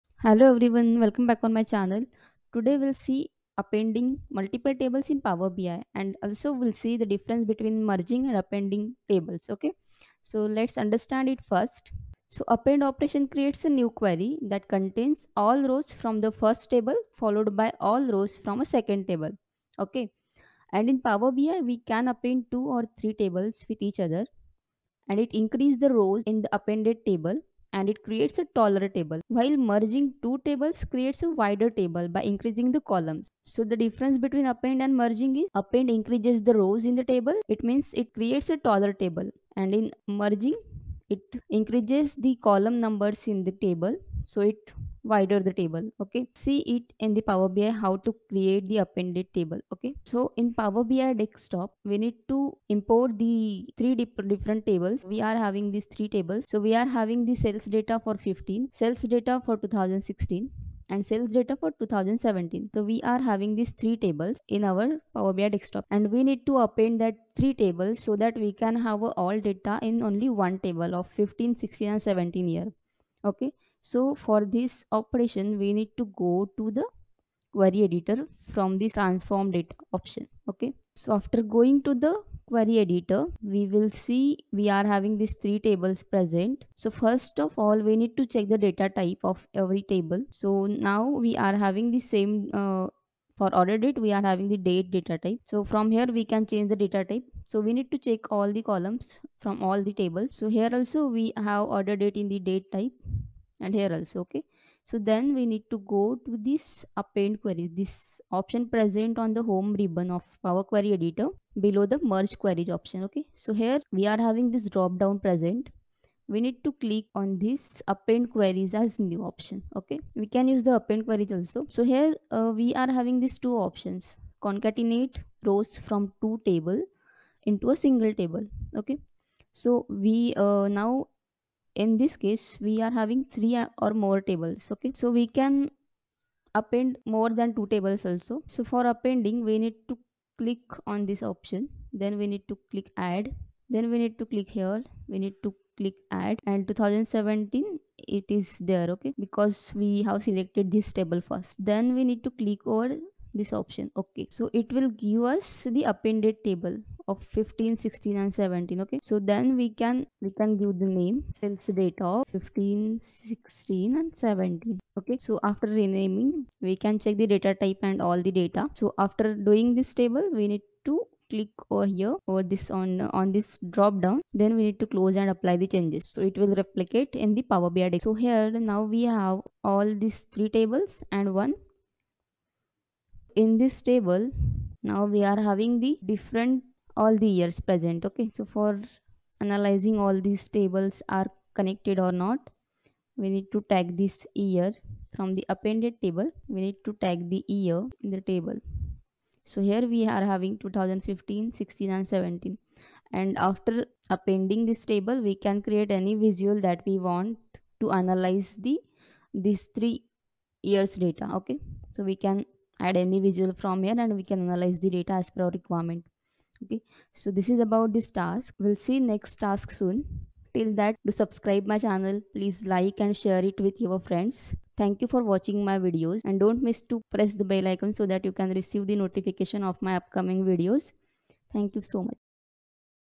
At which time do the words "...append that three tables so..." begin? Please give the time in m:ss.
1:06.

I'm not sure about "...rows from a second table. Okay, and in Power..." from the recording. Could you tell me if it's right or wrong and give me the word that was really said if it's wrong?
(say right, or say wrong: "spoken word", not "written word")
right.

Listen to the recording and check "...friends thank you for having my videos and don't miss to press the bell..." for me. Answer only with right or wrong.
wrong.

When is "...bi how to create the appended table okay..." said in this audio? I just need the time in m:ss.
0:47.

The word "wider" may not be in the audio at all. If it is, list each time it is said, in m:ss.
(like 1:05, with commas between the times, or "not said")
0:31, 0:45.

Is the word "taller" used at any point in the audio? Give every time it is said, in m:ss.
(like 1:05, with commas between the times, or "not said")
0:28, 0:38.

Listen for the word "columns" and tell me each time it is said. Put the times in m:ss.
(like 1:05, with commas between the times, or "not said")
0:32, 0:42, 1:38.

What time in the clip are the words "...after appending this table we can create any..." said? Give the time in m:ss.
3:23.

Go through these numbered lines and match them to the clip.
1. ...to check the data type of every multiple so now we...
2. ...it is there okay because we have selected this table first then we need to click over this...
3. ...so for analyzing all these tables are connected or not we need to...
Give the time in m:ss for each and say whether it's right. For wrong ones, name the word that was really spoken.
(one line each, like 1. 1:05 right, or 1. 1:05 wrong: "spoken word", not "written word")
1. 1:28 wrong: "table", not "multiple"
2. 2:28 right
3. 3:08 right.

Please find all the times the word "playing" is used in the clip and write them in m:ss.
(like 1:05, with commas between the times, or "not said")
not said.